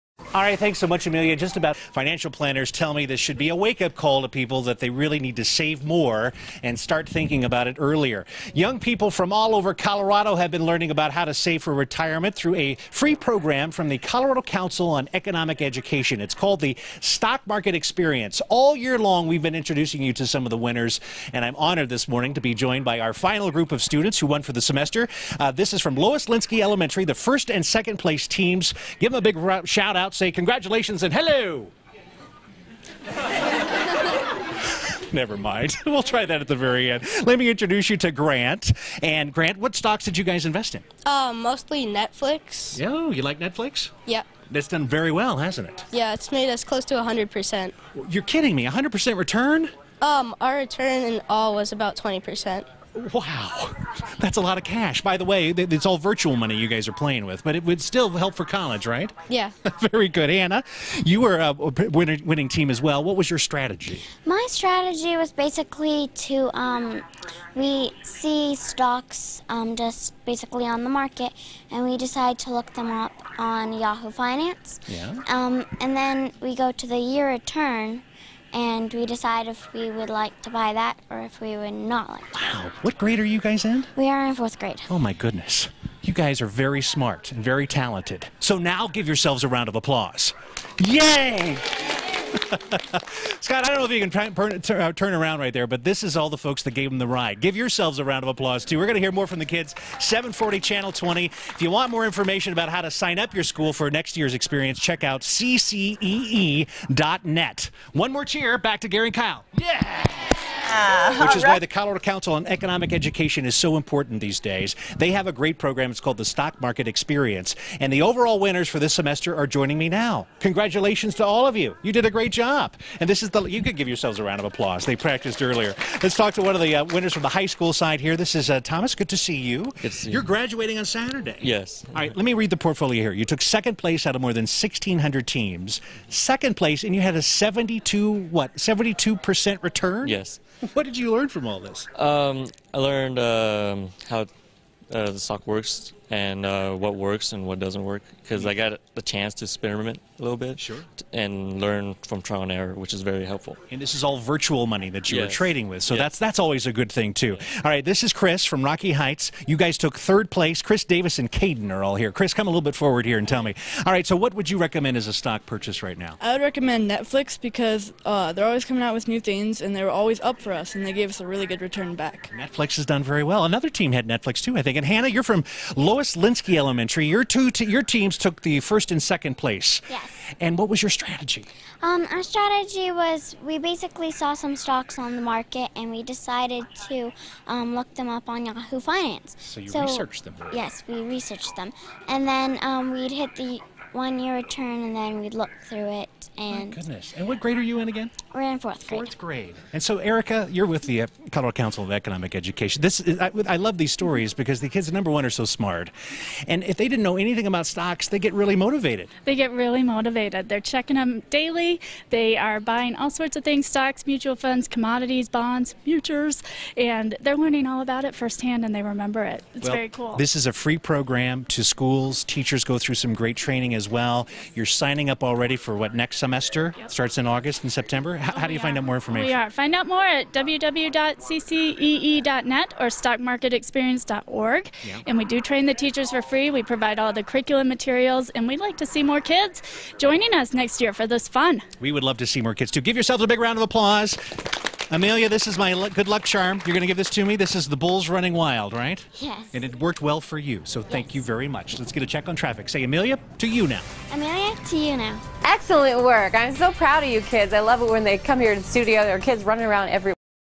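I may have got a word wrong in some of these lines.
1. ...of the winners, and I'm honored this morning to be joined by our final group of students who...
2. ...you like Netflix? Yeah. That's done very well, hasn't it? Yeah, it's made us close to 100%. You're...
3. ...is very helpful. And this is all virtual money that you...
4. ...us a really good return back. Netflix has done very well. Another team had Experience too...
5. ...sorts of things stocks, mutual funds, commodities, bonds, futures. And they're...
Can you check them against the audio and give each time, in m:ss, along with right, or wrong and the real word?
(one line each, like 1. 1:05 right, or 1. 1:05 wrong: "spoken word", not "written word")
1. 0:20 right
2. 0:43 right
3. 2:32 right
4. 2:51 wrong: "Netflix", not "Experience"
5. 3:33 right.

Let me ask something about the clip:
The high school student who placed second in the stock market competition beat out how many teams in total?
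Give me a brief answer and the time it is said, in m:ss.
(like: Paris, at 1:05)
More than 1,600, at 2:14.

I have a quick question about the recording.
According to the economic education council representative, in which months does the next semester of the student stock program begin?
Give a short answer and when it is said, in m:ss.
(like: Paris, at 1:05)
August and September, at 3:47.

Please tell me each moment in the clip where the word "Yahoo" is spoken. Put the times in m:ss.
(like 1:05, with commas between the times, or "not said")
1:13, 3:08.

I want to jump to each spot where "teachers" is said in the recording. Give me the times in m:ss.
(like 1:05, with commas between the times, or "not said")
3:42, 3:55.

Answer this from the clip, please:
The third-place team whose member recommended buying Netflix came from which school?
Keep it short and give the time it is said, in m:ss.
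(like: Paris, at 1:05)
Rocky Heights, at 2:38.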